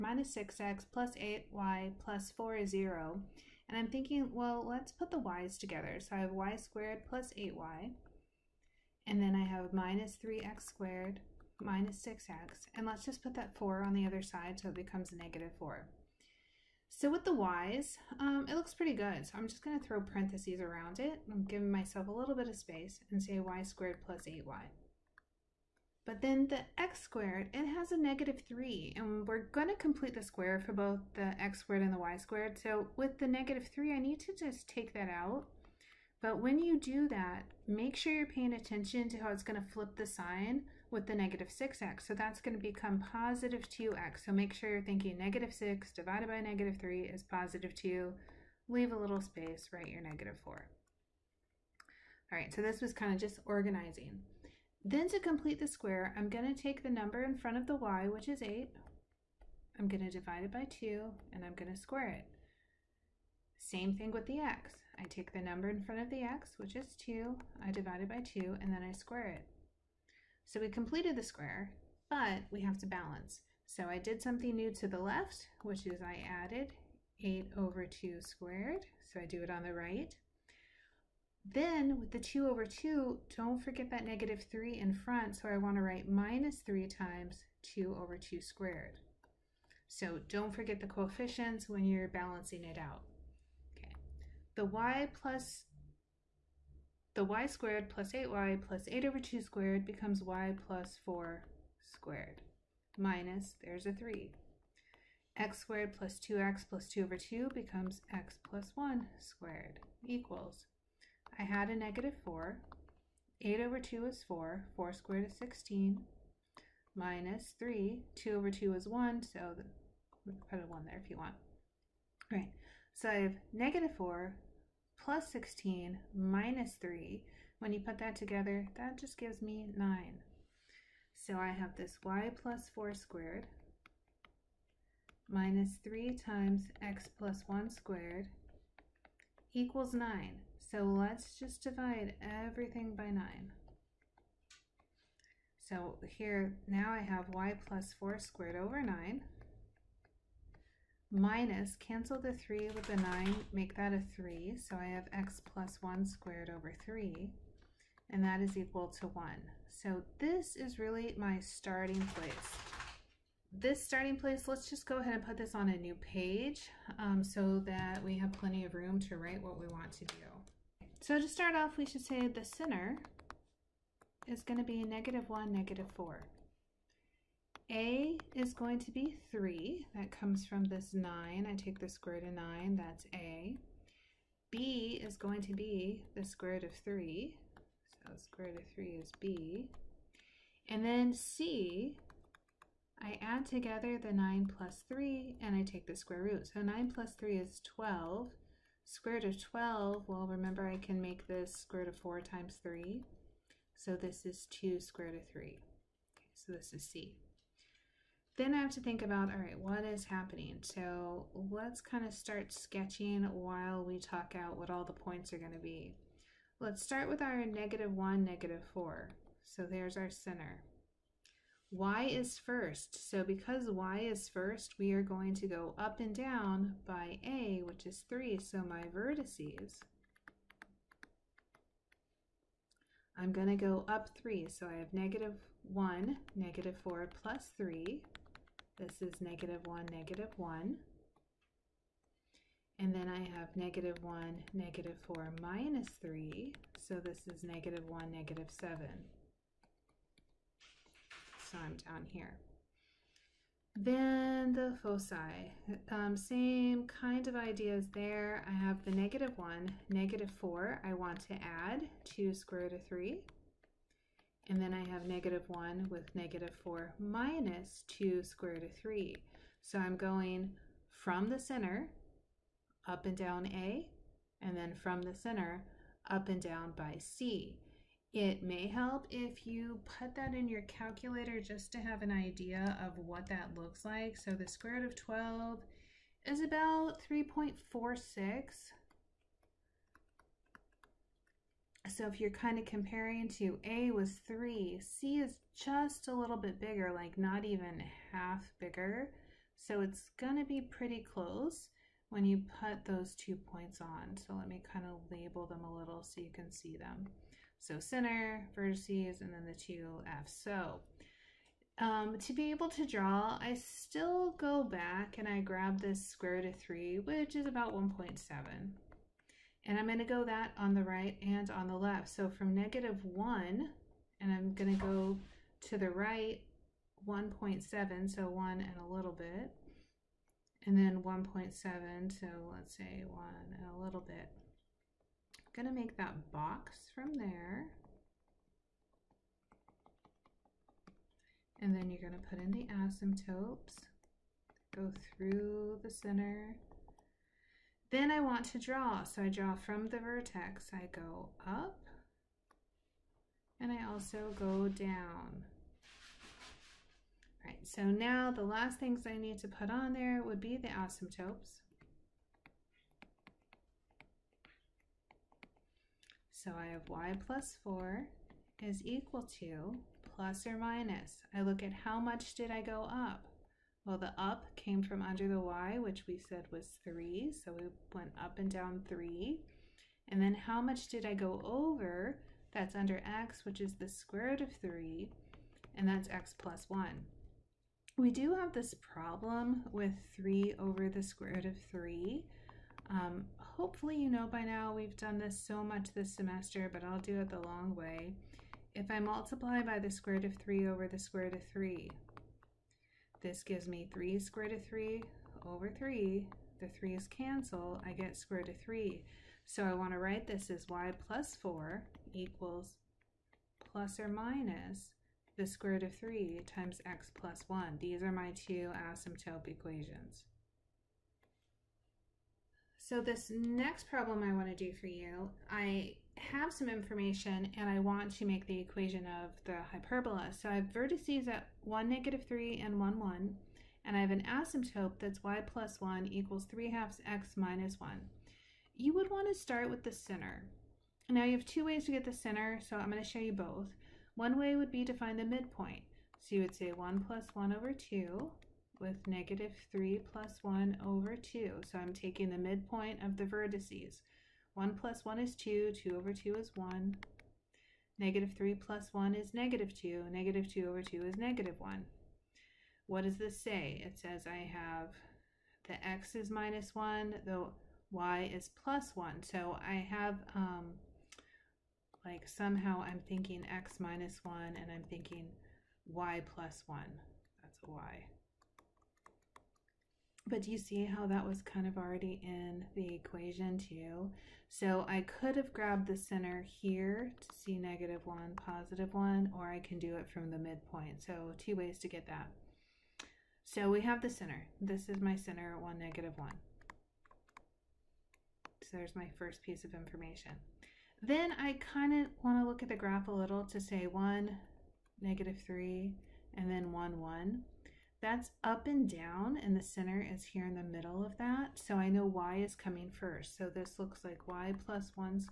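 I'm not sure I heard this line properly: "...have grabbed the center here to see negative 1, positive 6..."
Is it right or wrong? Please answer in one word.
wrong.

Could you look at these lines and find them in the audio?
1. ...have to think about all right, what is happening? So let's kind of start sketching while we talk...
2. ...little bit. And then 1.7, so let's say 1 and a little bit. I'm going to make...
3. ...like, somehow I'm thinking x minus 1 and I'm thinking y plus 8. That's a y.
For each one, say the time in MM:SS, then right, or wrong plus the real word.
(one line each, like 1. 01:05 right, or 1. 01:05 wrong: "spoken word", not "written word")
1. 03:28 right
2. 05:28 right
3. 07:52 wrong: "1", not "8".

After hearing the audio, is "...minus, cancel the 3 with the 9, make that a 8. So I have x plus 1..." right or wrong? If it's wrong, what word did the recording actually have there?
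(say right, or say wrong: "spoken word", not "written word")
wrong: "3", not "8".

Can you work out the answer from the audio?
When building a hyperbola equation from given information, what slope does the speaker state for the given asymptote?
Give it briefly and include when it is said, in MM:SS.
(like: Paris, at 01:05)
3/2, at 07:16.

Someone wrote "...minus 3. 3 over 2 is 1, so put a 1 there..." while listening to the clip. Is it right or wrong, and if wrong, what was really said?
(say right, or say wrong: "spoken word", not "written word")
wrong: "2", not "3".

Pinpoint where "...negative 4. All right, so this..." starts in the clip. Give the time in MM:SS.
00:50.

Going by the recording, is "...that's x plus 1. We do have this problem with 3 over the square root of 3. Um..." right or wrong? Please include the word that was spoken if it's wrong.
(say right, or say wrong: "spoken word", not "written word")
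right.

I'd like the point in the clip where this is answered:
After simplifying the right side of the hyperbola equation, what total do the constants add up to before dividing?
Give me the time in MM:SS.
02:08.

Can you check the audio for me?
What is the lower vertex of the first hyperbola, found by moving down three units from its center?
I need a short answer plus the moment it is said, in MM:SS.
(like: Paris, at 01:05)
(-1, -7), at 04:07.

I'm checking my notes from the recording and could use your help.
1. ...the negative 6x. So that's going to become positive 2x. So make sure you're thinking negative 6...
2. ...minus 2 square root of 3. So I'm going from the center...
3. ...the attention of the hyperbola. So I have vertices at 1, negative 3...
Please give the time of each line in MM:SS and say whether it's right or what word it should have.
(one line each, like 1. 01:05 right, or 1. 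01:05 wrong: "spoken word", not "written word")
1. 00:41 right
2. 04:26 right
3. 07:08 wrong: "equation", not "attention".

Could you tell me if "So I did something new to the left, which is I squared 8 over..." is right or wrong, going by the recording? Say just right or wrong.
wrong.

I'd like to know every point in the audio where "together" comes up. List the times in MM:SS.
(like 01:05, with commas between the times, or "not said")
00:05, 02:08, 03:13.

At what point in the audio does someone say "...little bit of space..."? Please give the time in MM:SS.
00:22.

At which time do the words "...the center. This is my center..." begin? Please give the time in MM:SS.
08:14.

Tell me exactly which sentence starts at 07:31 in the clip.
So I'm taking the midpoint of the vertices.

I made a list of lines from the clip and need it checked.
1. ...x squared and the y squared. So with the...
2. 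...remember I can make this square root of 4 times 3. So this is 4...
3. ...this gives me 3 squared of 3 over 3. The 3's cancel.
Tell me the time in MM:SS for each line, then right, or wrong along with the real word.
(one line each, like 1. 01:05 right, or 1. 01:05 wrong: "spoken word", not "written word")
1. 00:31 right
2. 03:20 wrong: "2", not "4"
3. 06:43 right.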